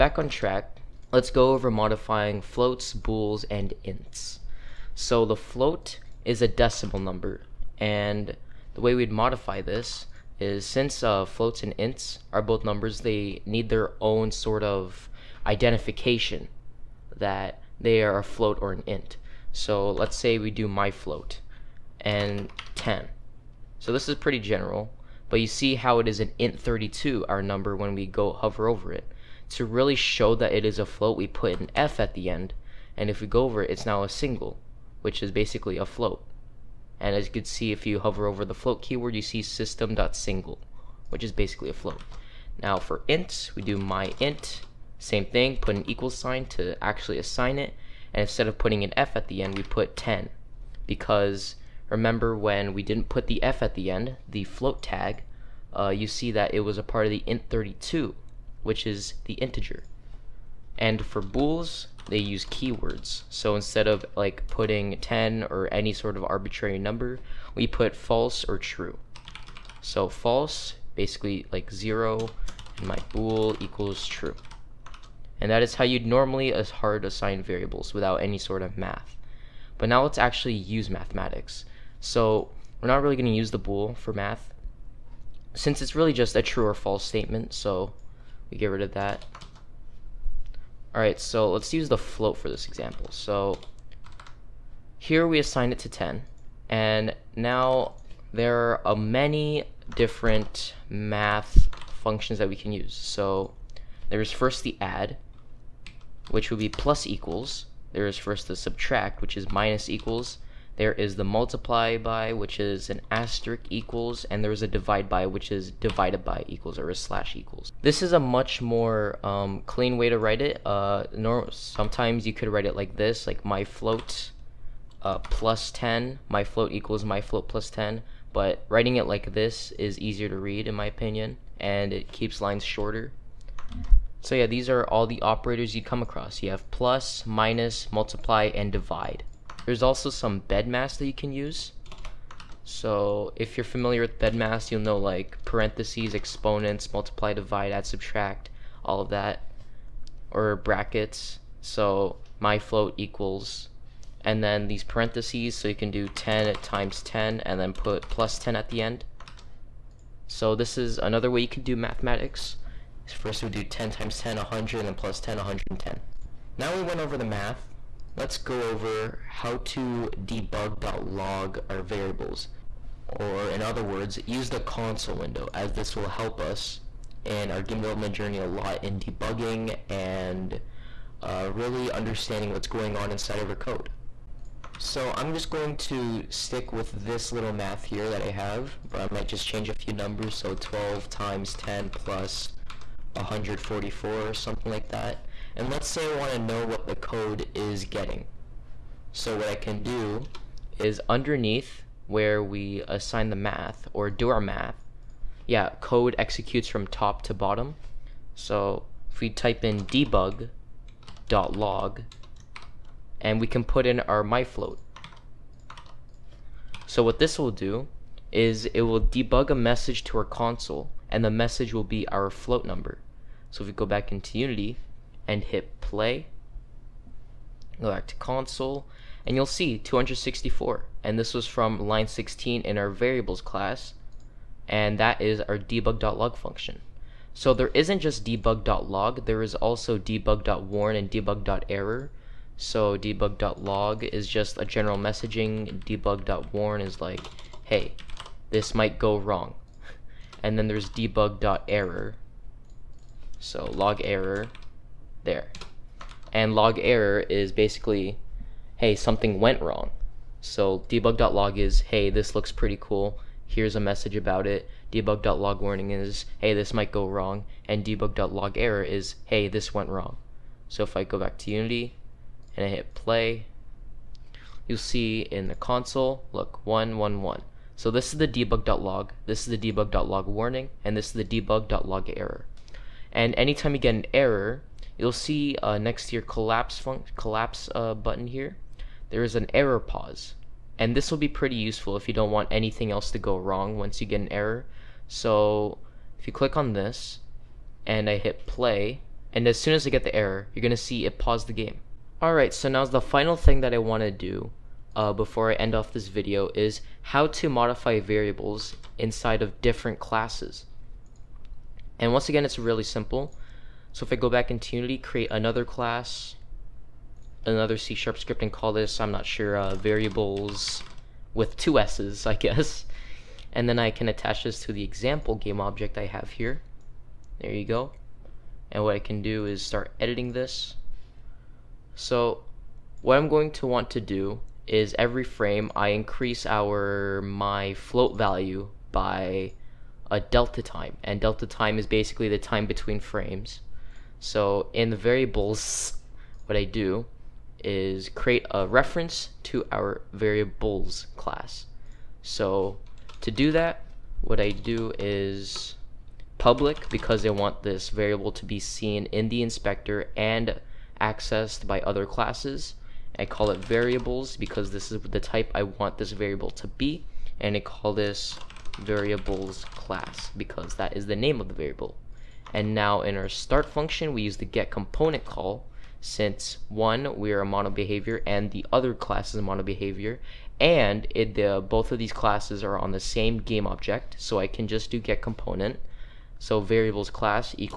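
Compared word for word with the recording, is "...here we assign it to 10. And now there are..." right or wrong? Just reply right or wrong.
right.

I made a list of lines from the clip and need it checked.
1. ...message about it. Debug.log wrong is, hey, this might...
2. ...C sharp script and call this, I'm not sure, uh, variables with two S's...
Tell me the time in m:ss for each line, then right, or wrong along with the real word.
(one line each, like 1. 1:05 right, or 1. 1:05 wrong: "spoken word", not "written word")
1. 4:23 wrong: "warning", not "wrong"
2. 5:17 right.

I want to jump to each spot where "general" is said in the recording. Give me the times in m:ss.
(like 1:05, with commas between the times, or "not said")
0:24, 4:04.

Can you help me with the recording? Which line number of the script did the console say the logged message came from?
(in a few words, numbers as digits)
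16.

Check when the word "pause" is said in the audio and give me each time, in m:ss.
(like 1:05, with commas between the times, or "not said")
4:49, 5:01.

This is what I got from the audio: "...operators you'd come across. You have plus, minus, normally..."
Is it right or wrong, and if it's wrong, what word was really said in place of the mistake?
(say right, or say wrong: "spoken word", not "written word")
wrong: "multiply", not "normally".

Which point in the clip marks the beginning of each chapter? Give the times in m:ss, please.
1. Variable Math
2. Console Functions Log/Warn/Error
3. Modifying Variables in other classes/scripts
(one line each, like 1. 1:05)
1. 1:19
2. 2:46
3. 5:01.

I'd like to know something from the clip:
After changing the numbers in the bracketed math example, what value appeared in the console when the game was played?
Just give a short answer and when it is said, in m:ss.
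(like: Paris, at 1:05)
264, at 3:49.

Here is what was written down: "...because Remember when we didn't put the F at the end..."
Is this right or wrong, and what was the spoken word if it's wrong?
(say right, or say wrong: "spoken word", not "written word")
right.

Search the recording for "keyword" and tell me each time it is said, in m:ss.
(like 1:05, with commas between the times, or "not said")
0:38, 1:02.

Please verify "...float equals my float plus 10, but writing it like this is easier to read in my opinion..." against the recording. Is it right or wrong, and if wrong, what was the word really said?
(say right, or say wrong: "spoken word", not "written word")
right.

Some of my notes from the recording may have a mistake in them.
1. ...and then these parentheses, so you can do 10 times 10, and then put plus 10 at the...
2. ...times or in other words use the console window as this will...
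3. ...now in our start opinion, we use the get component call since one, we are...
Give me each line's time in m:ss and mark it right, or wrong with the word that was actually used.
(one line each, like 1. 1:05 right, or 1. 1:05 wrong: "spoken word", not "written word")
1. 2:34 right
2. 2:51 wrong: "variables", not "times"
3. 6:12 wrong: "function", not "opinion".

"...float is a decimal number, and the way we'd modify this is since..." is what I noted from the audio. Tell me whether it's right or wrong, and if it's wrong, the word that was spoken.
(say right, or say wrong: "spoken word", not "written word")
right.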